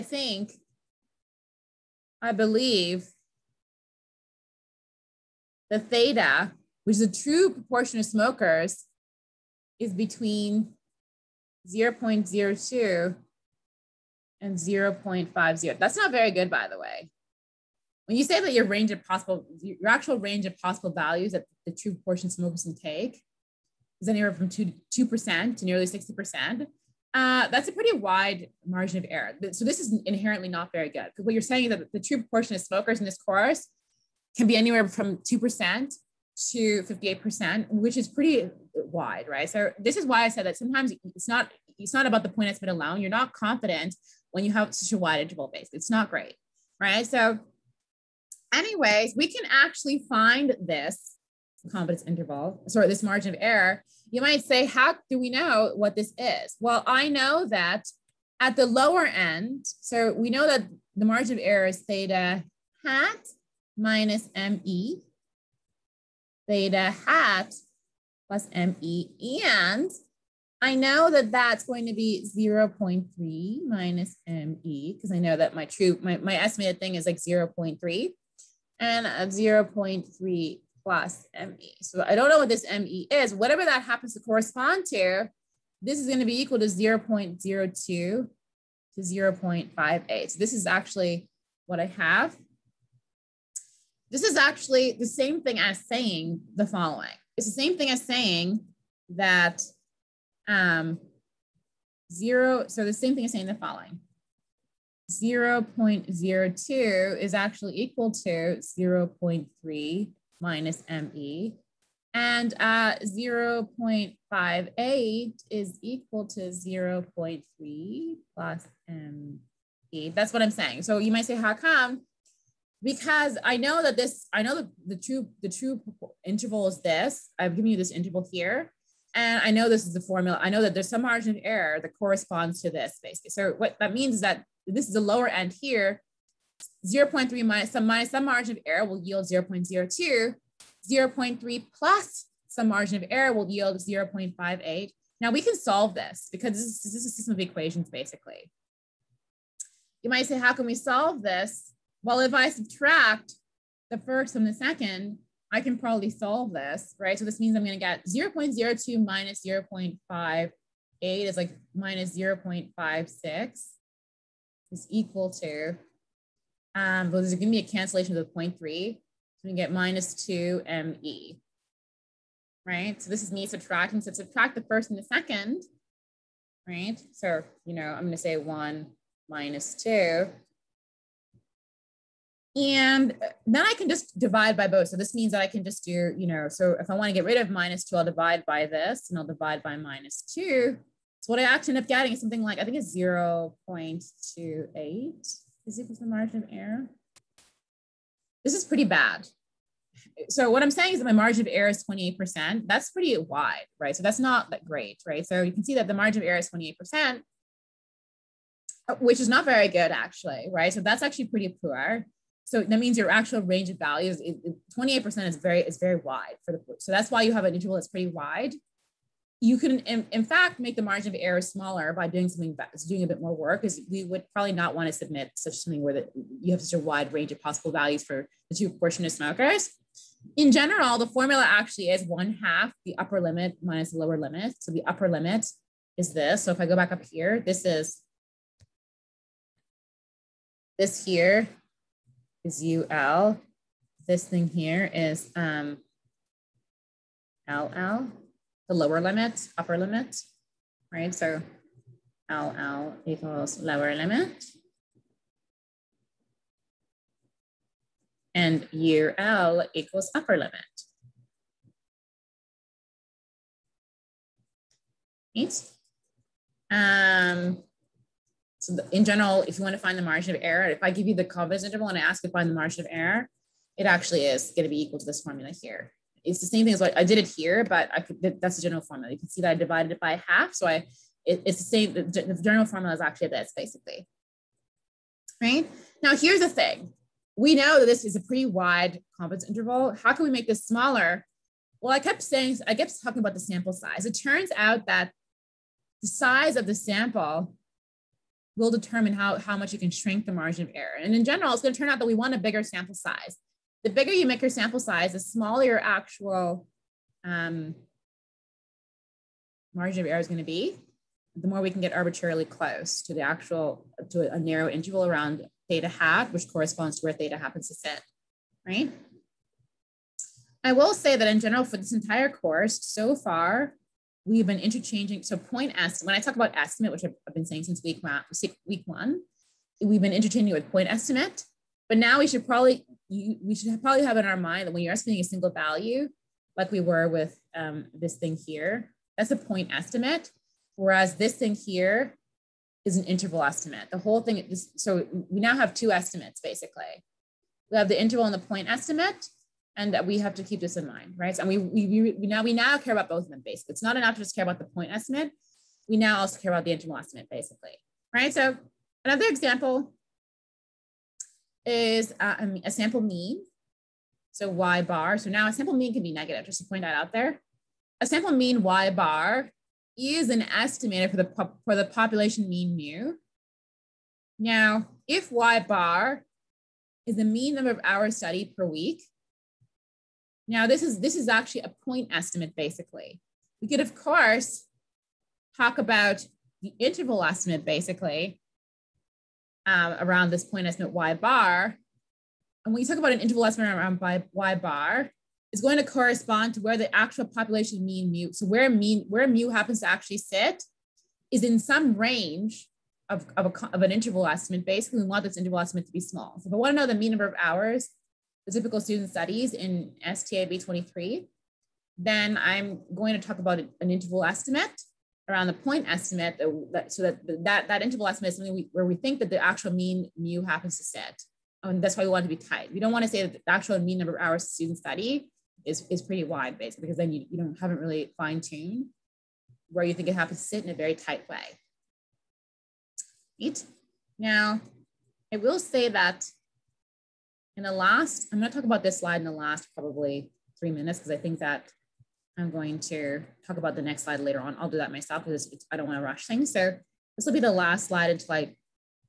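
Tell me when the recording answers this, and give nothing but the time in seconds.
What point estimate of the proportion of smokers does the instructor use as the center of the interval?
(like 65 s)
72 s.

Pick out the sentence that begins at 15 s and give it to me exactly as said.
That's not very good, by the way.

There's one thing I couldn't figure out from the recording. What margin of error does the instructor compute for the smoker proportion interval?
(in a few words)
0.28.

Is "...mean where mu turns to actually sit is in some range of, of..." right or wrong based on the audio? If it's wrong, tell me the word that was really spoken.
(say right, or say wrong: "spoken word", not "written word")
wrong: "happens", not "turns".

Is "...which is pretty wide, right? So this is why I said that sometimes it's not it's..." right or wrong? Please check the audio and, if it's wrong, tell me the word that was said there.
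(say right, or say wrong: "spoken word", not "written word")
right.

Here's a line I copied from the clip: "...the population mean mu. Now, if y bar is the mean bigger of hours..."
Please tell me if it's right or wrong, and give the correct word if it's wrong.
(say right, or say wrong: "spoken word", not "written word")
wrong: "number", not "bigger".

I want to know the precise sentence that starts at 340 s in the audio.
Whereas this thing here is an interval estimate.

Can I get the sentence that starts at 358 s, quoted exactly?
So another example is uh, a sample mean.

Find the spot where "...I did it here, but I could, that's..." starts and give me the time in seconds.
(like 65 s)
276 s.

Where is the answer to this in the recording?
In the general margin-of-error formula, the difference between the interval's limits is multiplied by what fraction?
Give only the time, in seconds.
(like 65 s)
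232 s.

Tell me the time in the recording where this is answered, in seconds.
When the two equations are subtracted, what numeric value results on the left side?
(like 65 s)
161 s.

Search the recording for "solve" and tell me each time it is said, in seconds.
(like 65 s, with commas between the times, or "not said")
145 s, 150 s, 156 s.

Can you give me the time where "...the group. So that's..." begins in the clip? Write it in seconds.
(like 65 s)
216 s.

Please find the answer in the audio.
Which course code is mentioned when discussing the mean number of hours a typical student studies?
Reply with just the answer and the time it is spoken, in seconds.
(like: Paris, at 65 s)
STAB 23, at 410 s.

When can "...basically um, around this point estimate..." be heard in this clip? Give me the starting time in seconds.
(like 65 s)
387 s.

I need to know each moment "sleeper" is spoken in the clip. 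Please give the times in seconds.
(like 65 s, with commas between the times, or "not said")
not said.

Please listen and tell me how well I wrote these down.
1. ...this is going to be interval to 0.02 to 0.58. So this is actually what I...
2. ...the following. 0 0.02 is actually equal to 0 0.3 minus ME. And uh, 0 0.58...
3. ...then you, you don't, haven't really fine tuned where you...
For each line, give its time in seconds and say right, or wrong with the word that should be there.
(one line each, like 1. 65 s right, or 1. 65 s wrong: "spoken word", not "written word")
1. 85 s wrong: "equal", not "interval"
2. 103 s right
3. 426 s right.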